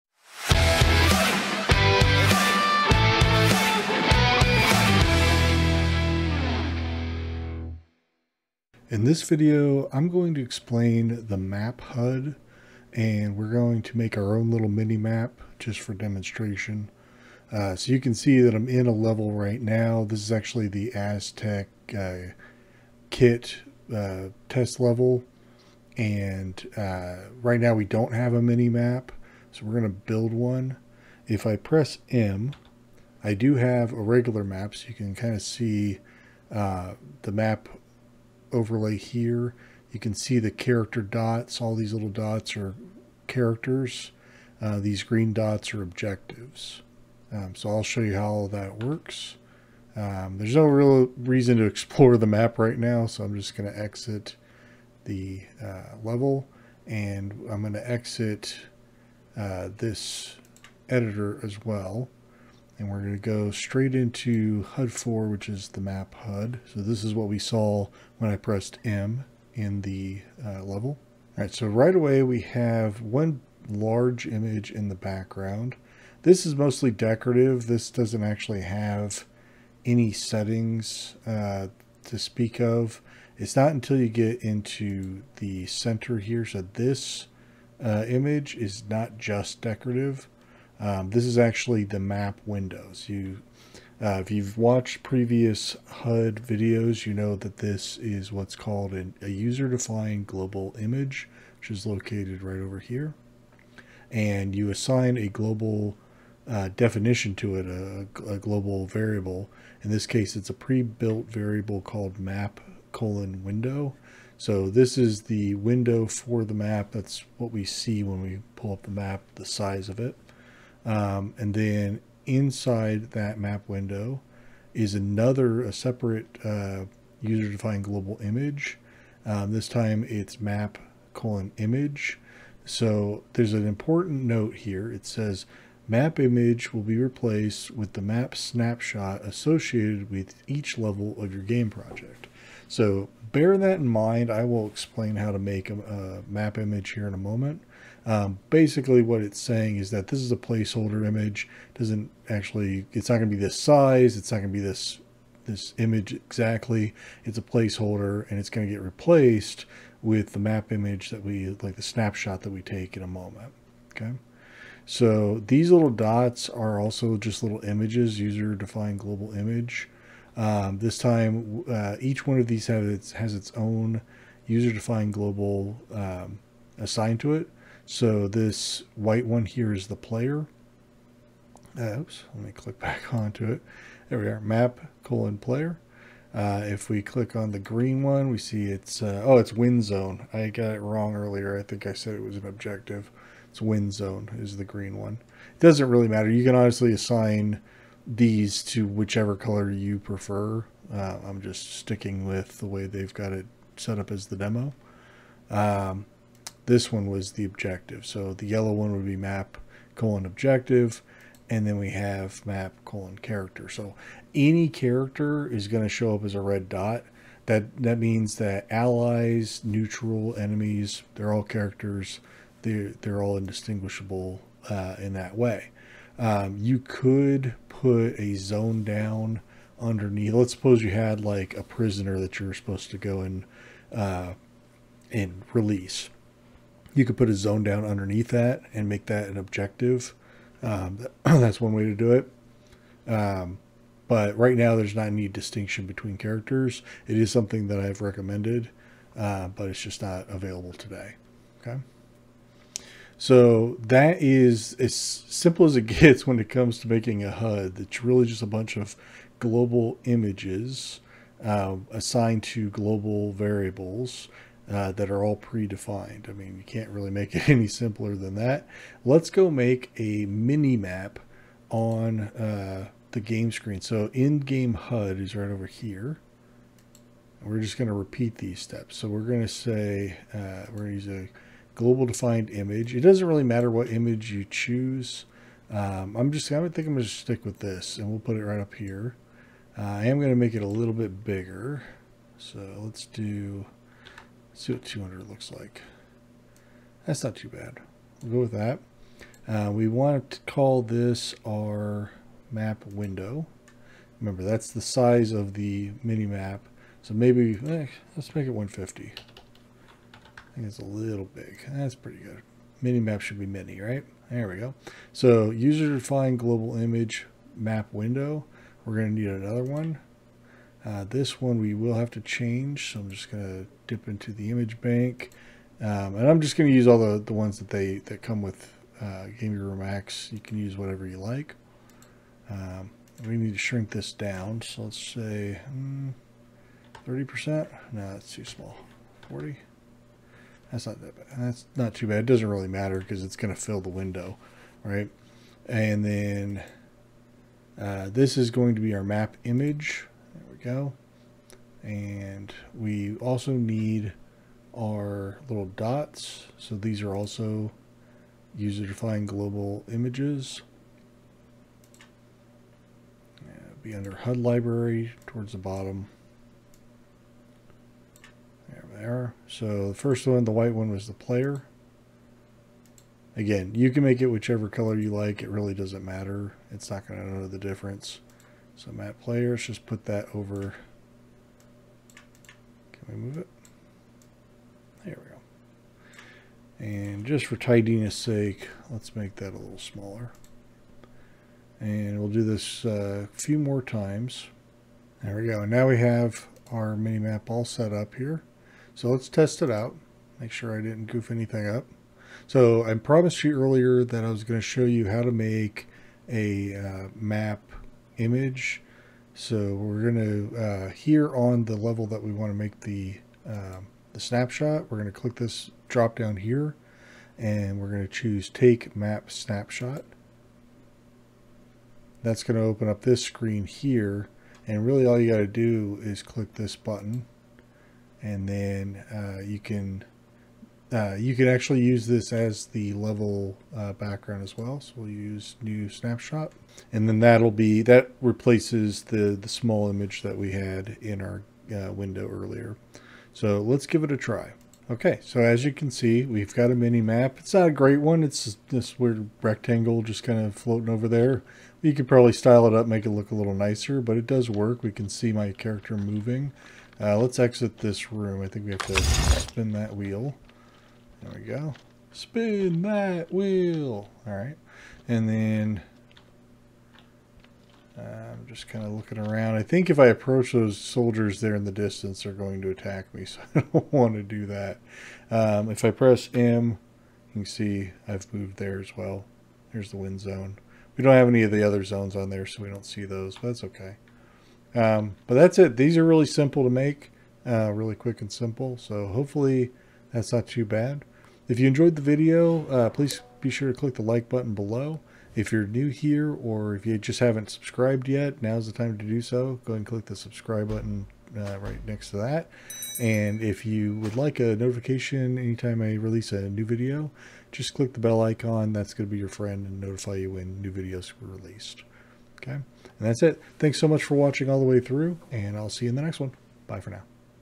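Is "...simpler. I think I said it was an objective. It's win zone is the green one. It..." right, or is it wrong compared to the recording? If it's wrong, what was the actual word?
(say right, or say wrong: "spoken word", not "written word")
wrong: "earlier", not "simpler".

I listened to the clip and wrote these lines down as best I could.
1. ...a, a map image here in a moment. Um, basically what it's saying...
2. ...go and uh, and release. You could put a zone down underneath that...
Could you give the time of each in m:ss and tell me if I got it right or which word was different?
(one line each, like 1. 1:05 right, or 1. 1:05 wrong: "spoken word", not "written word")
1. 2:25 right
2. 3:52 right.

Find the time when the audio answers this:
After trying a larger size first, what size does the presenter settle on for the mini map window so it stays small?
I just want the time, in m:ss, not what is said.
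5:08.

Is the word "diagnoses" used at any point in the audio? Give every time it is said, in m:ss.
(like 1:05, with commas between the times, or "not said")
not said.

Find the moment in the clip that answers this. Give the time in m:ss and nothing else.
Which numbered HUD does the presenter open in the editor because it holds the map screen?
1:04.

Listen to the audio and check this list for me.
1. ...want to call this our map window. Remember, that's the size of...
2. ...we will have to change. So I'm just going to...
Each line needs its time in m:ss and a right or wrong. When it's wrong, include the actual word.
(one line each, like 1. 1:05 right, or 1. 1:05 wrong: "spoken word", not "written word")
1. 4:59 right
2. 5:21 right.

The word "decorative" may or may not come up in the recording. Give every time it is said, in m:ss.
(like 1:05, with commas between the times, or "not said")
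1:16, 1:29.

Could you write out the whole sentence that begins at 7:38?
I think we have to spin that wheel.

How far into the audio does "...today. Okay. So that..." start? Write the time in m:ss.
4:10.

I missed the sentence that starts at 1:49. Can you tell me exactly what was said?
In this case, it's a pre-built variable called map colon window.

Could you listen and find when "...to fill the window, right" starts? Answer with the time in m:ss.
5:43.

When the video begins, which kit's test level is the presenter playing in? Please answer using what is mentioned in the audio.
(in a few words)
Aztec.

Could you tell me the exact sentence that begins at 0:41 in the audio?
All these little dots are characters.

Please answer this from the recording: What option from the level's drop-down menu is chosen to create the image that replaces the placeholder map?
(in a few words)
take map snapshot.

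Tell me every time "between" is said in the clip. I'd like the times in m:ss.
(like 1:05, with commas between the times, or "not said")
4:05.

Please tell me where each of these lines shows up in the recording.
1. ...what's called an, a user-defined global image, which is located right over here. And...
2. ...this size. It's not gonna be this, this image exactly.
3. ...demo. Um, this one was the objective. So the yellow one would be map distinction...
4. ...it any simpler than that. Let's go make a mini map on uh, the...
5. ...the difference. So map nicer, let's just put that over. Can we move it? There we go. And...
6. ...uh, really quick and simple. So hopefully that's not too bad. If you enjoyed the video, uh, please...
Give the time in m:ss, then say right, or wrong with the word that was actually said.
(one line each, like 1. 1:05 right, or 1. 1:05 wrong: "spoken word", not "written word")
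1. 1:38 right
2. 2:33 right
3. 3:24 wrong: "colon", not "distinction"
4. 4:27 right
5. 6:17 wrong: "player", not "nicer"
6. 8:07 right.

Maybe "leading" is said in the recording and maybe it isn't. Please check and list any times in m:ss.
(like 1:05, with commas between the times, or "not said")
not said.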